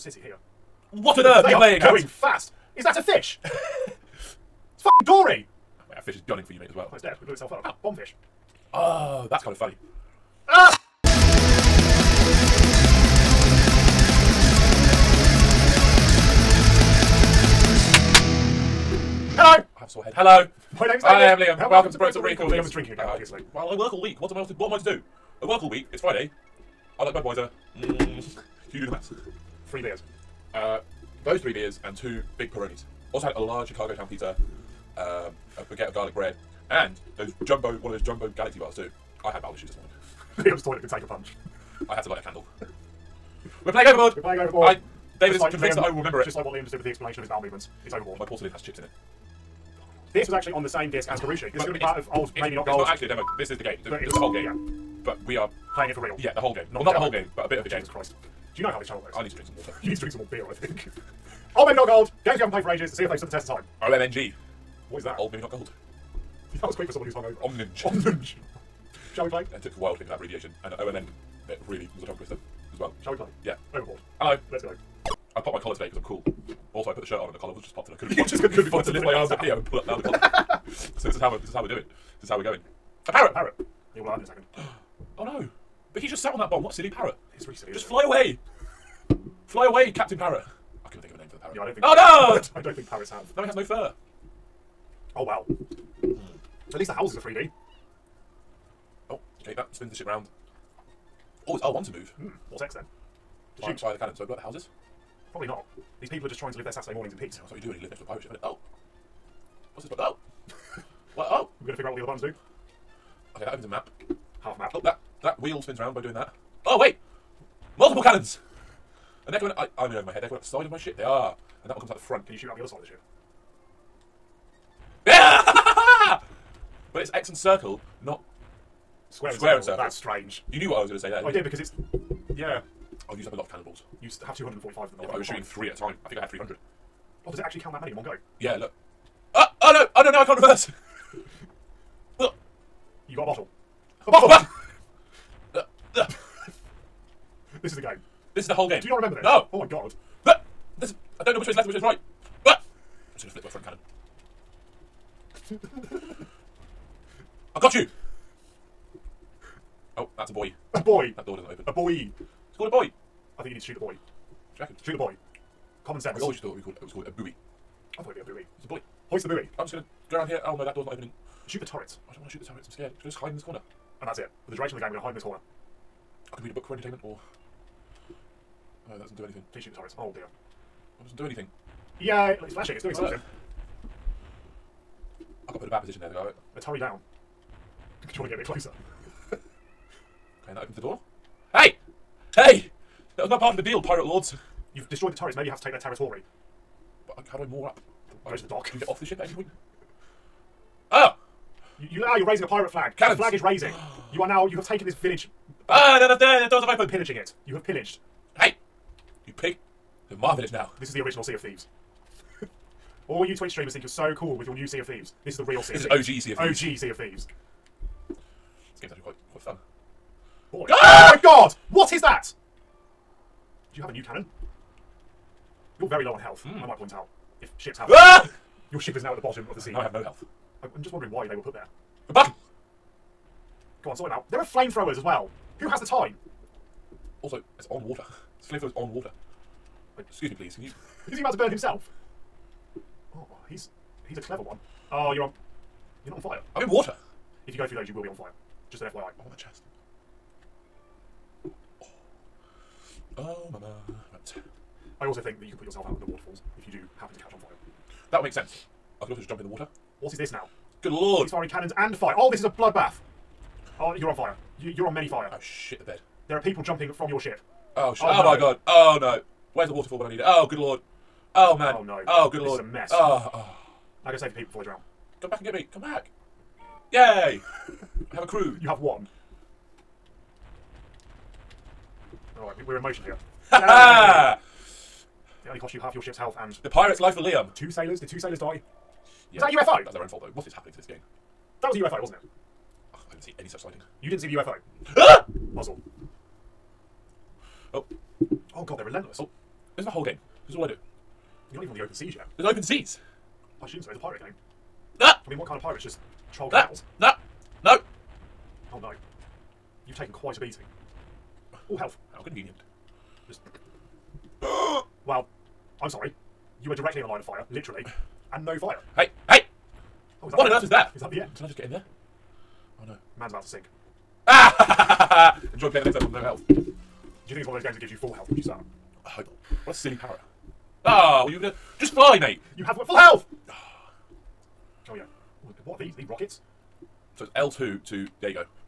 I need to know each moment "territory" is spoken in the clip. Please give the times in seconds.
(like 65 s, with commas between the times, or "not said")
195 s.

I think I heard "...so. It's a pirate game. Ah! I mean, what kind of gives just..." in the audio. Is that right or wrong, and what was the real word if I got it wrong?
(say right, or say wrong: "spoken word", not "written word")
wrong: "pirates", not "gives".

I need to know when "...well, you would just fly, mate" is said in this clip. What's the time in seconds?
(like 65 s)
331 s.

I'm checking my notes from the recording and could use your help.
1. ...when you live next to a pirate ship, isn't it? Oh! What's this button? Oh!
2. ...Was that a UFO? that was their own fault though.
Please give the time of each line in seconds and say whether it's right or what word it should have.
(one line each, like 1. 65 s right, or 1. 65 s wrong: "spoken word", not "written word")
1. 107 s right
2. 289 s right.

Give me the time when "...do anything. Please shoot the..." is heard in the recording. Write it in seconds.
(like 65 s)
179 s.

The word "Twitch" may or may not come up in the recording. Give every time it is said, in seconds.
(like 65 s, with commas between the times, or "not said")
213 s.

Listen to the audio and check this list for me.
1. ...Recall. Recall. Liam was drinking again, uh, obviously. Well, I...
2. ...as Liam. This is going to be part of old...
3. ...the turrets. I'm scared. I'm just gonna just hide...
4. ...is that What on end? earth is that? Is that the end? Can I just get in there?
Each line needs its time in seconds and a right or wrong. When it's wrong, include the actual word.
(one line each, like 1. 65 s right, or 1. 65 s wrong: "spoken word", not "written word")
1. 22 s right
2. 51 s wrong: "Karushi", not "Liam"
3. 172 s right
4. 320 s right.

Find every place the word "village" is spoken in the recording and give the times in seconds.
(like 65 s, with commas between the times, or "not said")
204 s, 210 s.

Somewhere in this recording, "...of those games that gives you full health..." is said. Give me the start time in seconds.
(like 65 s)
327 s.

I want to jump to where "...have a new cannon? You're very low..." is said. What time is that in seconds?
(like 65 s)
223 s.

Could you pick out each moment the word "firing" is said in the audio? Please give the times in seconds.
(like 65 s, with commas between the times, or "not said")
261 s.